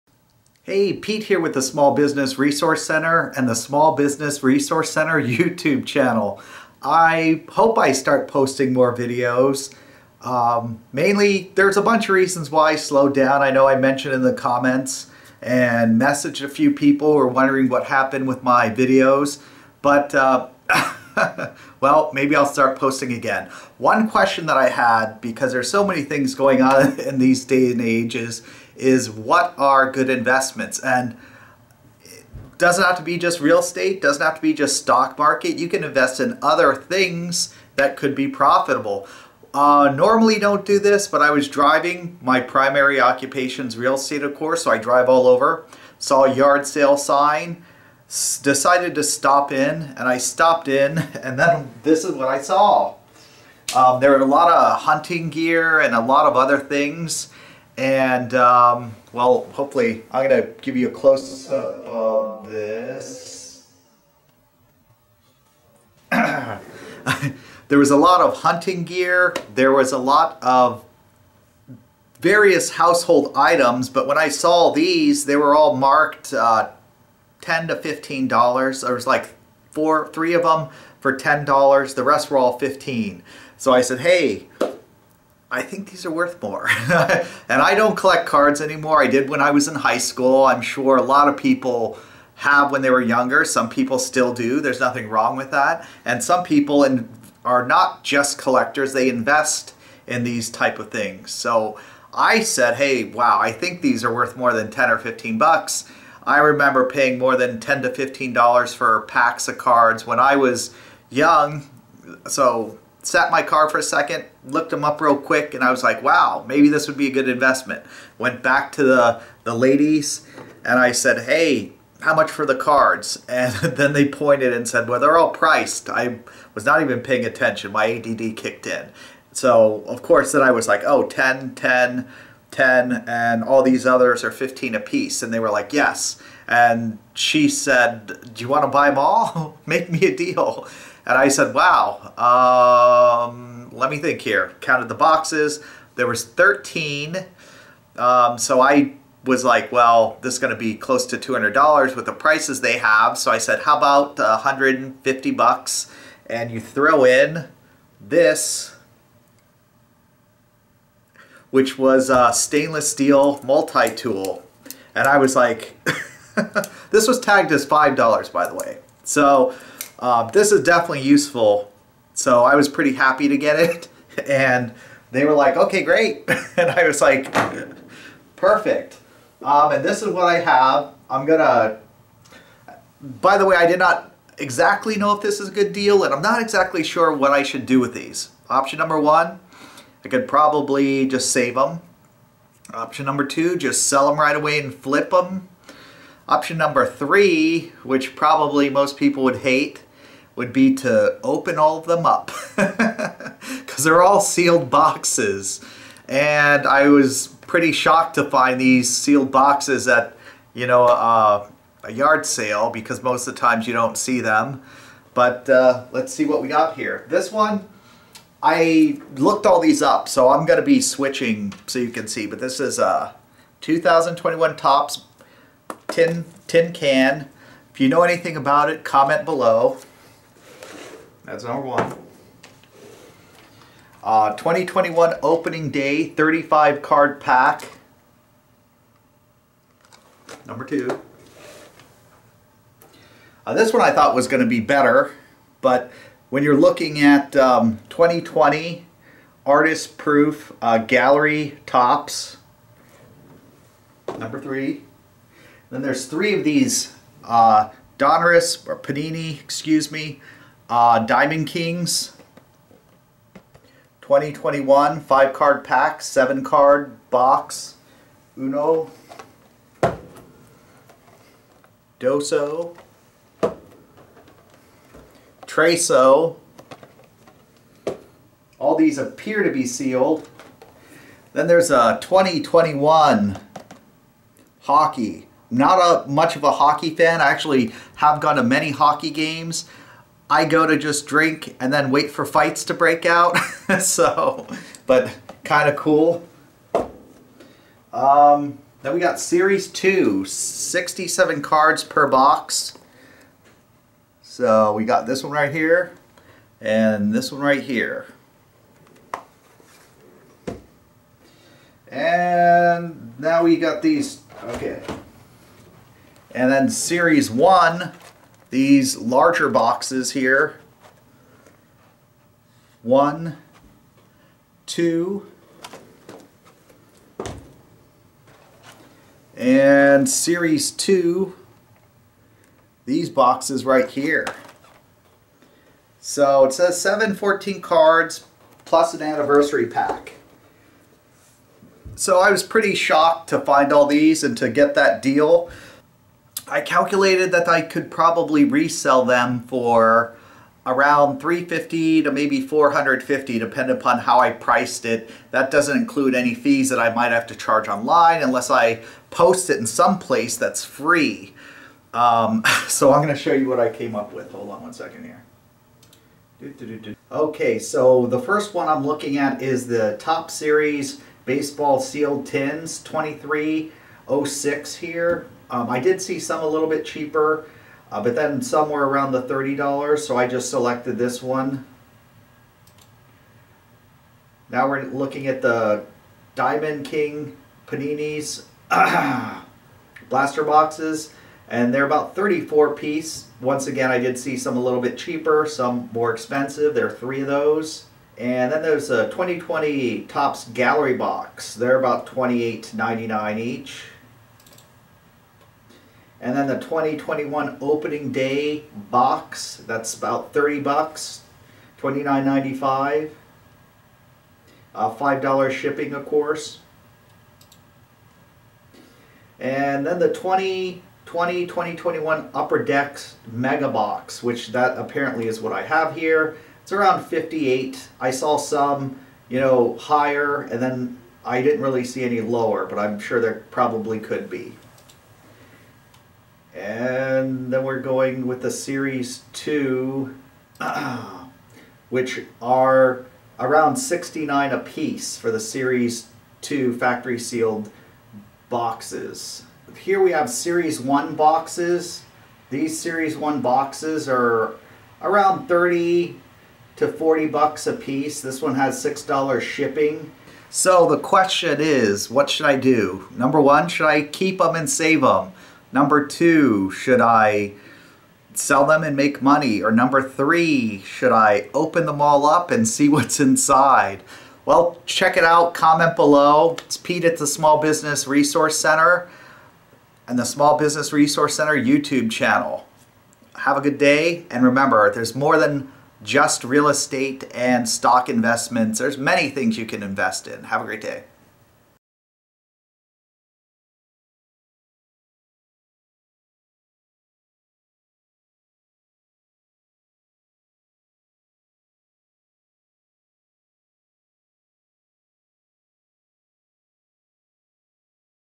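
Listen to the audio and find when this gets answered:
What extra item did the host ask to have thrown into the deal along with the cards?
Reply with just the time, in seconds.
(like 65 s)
162 s.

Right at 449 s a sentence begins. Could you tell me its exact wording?
Here we have Series 1 boxes.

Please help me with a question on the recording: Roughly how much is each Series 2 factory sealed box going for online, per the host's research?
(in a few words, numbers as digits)
$69.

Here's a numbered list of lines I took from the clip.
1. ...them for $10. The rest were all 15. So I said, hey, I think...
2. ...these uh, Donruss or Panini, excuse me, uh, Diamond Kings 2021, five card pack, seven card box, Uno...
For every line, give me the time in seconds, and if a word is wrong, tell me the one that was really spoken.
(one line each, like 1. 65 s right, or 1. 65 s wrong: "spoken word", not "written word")
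1. 80 s right
2. 256 s right.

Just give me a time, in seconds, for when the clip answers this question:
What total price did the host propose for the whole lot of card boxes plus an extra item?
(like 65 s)
154 s.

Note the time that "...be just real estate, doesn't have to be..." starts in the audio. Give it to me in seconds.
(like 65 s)
33 s.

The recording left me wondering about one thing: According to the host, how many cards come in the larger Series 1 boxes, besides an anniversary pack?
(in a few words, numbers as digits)
714.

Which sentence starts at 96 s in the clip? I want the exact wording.
And some people in, are not just collectors.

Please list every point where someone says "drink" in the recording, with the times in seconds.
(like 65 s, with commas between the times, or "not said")
291 s.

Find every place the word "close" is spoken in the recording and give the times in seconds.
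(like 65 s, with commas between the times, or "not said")
60 s, 150 s.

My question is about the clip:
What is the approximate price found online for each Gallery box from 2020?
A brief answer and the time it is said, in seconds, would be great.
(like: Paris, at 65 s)
$28.99, at 402 s.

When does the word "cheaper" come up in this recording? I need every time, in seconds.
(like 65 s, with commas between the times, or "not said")
376 s, 394 s.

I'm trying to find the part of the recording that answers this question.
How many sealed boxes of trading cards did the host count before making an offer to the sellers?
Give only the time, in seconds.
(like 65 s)
145 s.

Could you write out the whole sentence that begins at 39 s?
Uh, normally don't do this, but I was driving.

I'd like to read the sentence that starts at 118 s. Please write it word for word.
Went back to the, the ladies and I said, hey, how much for the cards?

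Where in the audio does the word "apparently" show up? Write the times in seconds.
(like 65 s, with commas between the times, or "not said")
424 s.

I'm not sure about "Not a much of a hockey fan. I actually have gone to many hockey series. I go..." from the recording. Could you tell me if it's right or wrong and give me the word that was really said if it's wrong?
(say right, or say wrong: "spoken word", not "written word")
wrong: "games", not "series".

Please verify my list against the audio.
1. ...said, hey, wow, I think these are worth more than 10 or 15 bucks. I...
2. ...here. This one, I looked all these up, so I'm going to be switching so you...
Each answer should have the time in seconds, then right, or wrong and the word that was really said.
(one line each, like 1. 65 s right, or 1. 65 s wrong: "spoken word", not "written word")
1. 102 s right
2. 216 s right.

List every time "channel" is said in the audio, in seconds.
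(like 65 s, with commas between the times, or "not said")
5 s, 482 s.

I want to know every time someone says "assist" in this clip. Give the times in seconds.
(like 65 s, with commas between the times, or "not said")
not said.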